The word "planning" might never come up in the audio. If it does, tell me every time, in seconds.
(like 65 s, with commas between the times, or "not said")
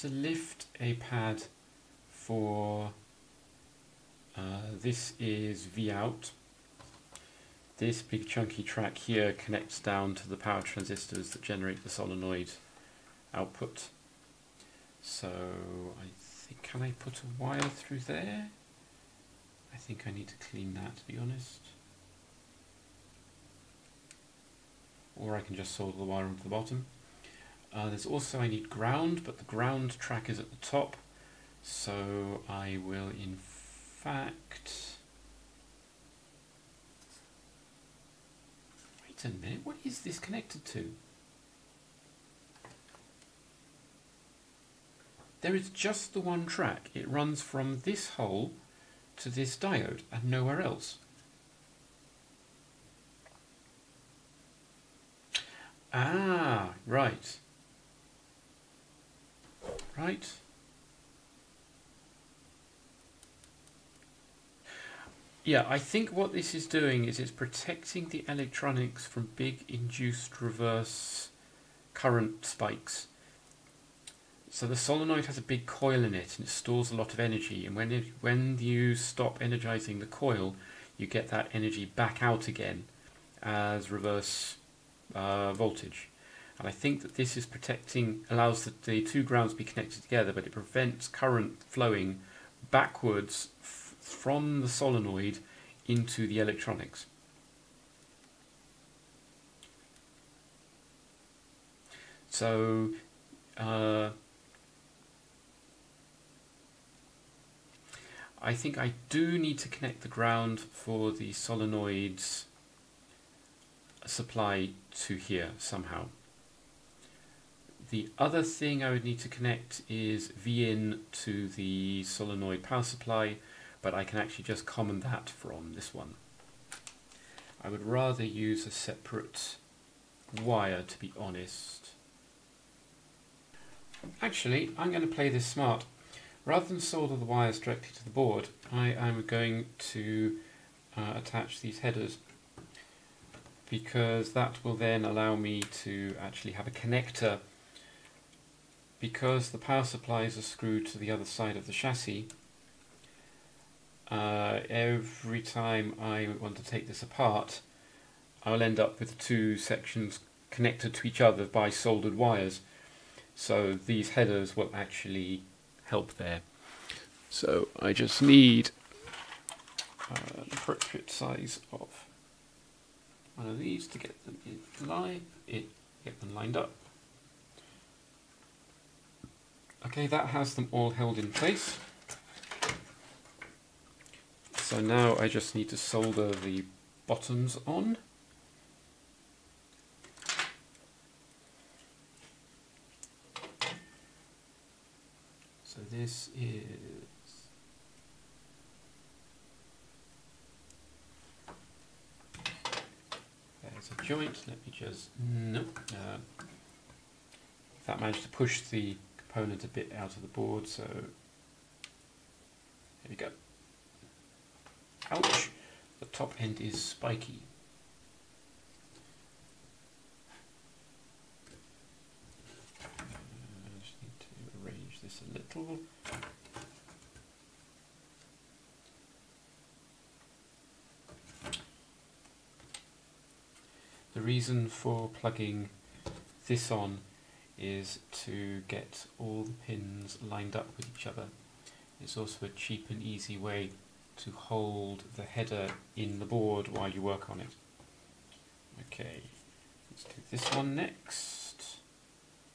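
not said.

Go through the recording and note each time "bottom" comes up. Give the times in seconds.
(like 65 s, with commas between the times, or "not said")
26 s, 187 s.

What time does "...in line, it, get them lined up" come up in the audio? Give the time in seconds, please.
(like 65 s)
174 s.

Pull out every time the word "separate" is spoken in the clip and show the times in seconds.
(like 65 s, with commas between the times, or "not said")
128 s.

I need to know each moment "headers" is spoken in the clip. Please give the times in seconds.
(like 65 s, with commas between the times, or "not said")
141 s, 164 s, 245 s.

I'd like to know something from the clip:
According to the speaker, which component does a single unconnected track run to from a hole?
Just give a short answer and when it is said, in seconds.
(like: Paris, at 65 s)
diode, at 49 s.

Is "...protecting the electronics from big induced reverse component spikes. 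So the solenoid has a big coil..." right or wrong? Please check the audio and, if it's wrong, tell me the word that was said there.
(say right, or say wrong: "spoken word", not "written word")
wrong: "current", not "component".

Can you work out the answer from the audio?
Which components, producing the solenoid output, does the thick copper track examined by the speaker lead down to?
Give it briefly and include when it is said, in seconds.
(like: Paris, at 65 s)
power transistors, at 10 s.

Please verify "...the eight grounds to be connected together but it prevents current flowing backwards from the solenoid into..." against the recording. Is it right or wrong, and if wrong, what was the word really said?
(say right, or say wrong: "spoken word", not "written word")
wrong: "two", not "eight".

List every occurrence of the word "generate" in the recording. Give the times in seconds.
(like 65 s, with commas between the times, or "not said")
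11 s.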